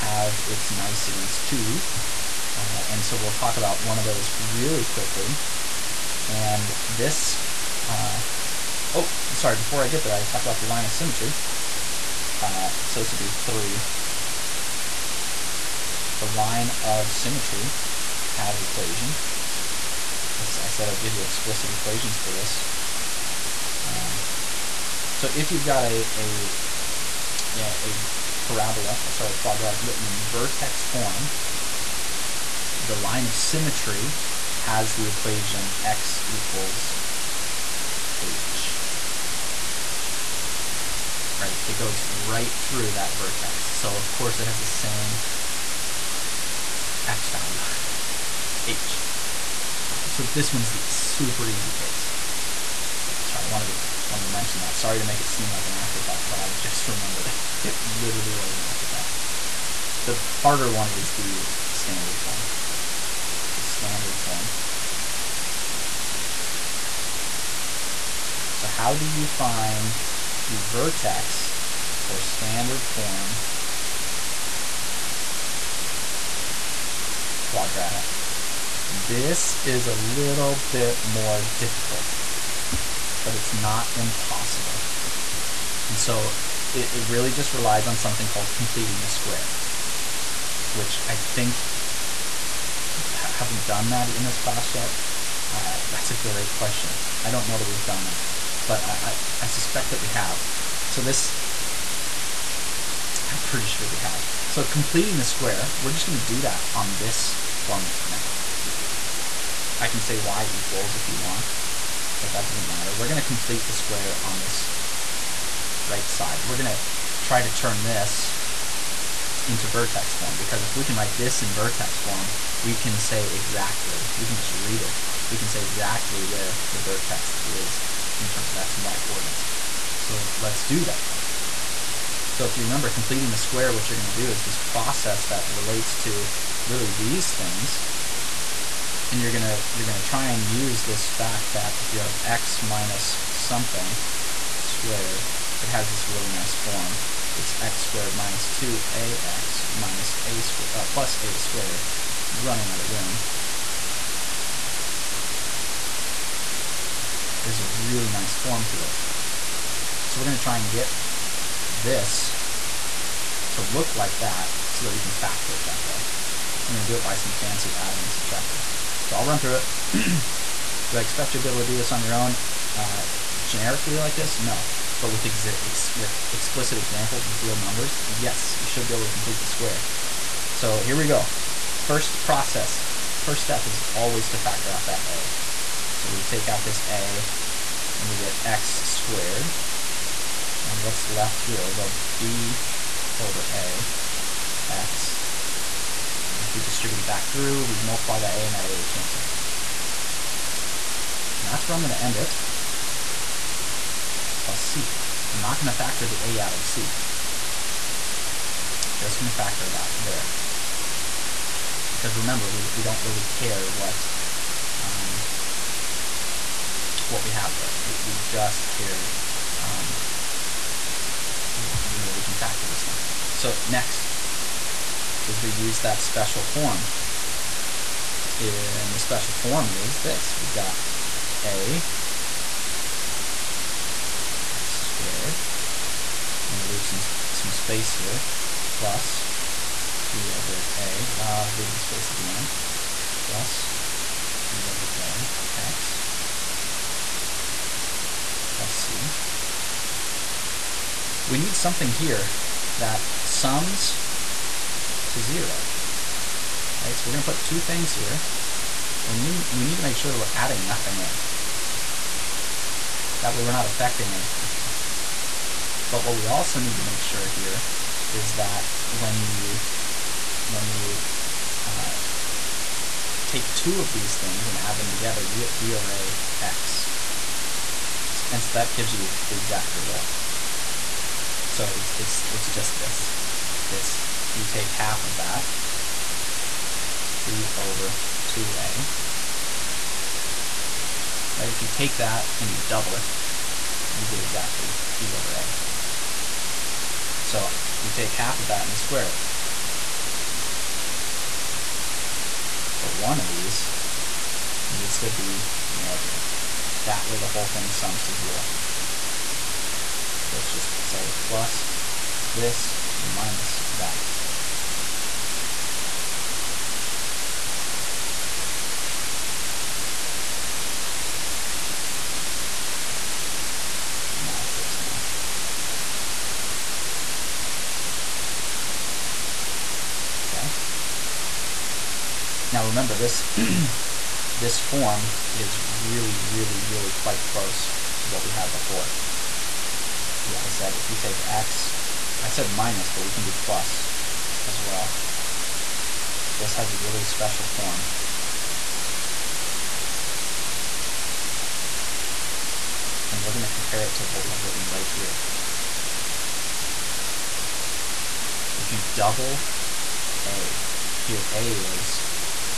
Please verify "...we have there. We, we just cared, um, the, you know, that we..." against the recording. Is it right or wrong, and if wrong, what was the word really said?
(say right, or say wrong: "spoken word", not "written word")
right.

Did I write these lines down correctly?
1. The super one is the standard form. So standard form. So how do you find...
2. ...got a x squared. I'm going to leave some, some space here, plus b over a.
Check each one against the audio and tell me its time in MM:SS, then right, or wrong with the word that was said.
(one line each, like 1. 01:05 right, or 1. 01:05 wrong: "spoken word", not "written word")
1. 01:00 wrong: "harder", not "super"
2. 03:50 right.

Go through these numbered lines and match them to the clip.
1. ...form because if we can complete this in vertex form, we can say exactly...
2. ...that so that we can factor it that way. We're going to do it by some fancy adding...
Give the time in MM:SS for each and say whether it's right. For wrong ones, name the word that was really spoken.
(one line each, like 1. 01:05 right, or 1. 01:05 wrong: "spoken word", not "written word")
1. 02:00 wrong: "write", not "complete"
2. 02:44 right.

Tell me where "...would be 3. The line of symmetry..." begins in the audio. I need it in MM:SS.
00:13.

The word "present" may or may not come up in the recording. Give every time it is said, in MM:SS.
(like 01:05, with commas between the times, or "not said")
not said.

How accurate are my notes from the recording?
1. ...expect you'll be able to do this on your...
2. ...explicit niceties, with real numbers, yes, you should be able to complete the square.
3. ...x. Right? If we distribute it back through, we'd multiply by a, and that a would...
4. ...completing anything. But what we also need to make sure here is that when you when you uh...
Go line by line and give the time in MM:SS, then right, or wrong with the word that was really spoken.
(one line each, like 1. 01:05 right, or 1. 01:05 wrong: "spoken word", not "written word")
1. 02:51 right
2. 02:56 wrong: "examples", not "niceties"
3. 03:14 right
4. 04:23 wrong: "affecting", not "completing".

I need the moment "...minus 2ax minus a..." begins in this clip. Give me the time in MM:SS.
02:28.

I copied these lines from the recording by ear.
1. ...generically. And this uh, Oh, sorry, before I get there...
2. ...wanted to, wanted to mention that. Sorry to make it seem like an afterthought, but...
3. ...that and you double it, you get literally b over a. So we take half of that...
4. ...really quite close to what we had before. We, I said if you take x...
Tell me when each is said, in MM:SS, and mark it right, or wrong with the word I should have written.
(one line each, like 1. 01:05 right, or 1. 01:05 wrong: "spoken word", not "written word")
1. 00:04 wrong: "quickly", not "generically"
2. 00:53 right
3. 04:51 wrong: "exactly", not "literally"
4. 05:36 right.